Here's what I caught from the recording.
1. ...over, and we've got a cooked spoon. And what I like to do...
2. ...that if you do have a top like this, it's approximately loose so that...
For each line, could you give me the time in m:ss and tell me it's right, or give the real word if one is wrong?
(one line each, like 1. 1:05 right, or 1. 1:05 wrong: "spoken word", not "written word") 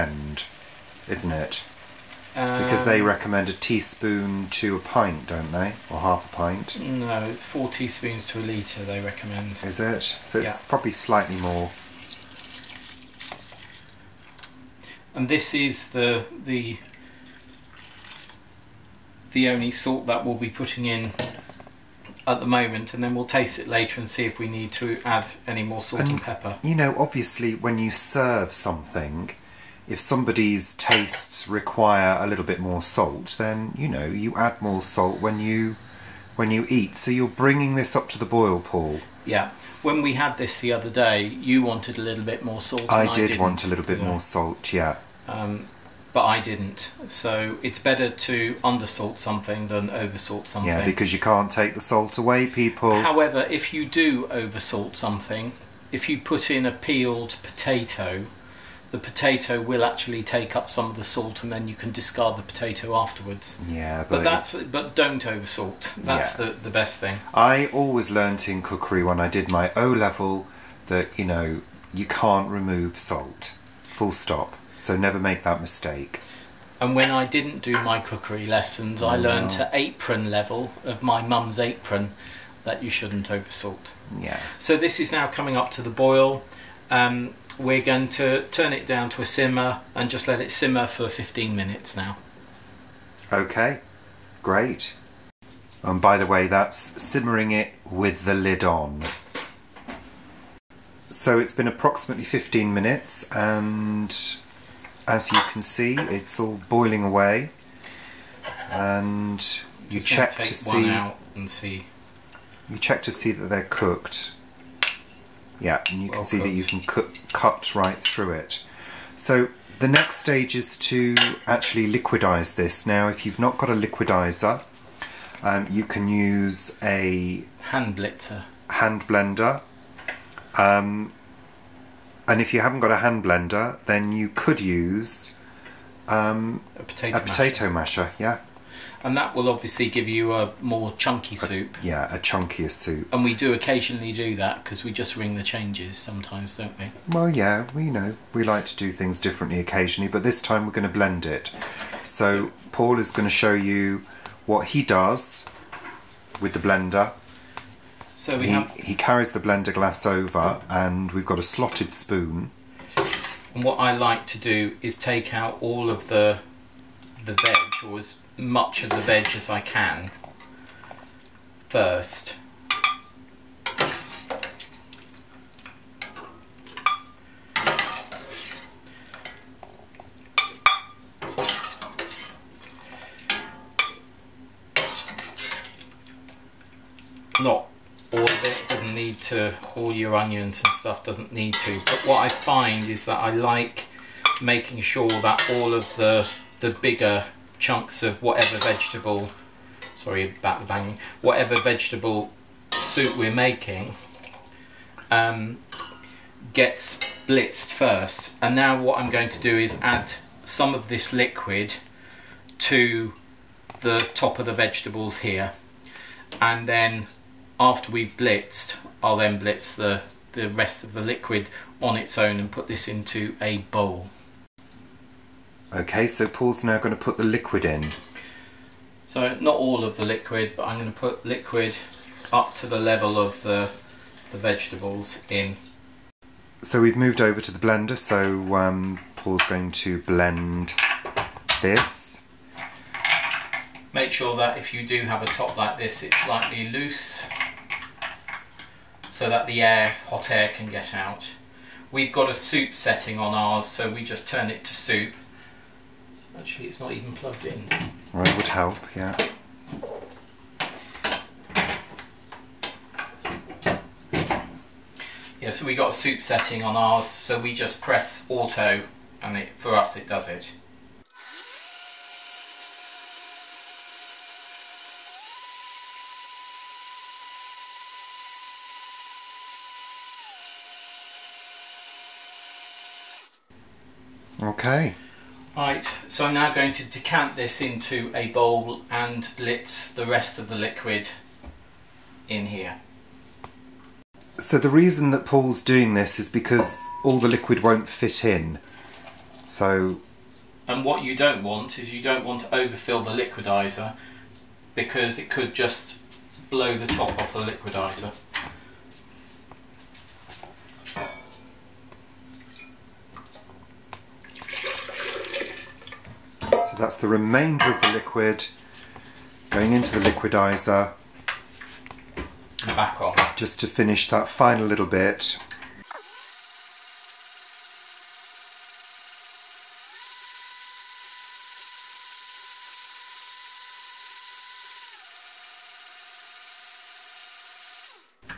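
1. 2:40 wrong: "slotted", not "cooked"
2. 4:04 wrong: "slightly", not "approximately".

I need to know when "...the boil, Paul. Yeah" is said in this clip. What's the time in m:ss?
0:38.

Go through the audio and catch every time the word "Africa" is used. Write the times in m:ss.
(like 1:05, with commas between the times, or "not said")
not said.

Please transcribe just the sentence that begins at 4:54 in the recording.
So the reason that Paul's doing this is because all the liquid won't fit in.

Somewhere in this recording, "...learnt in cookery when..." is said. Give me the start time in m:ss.
1:08.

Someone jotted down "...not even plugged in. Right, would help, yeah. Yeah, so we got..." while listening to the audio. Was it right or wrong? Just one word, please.
right.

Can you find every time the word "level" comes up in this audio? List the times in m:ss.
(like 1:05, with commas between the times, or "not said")
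1:09, 1:20, 3:52.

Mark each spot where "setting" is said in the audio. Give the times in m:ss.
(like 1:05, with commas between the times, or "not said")
4:12, 4:26.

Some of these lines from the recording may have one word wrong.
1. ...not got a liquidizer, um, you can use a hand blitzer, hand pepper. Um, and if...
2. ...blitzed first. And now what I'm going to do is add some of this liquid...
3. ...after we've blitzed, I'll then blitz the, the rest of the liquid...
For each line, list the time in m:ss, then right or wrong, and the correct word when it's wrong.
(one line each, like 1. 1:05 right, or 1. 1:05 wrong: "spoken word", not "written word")
1. 2:03 wrong: "blender", not "pepper"
2. 3:27 right
3. 3:37 right.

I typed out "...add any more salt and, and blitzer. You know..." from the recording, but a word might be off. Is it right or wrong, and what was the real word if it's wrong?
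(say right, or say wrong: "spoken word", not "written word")
wrong: "pepper", not "blitzer".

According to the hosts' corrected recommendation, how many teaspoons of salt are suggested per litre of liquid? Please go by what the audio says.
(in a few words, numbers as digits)
4.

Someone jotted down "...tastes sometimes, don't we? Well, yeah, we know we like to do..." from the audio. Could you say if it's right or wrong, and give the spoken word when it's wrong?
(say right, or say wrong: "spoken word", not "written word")
wrong: "changes", not "tastes".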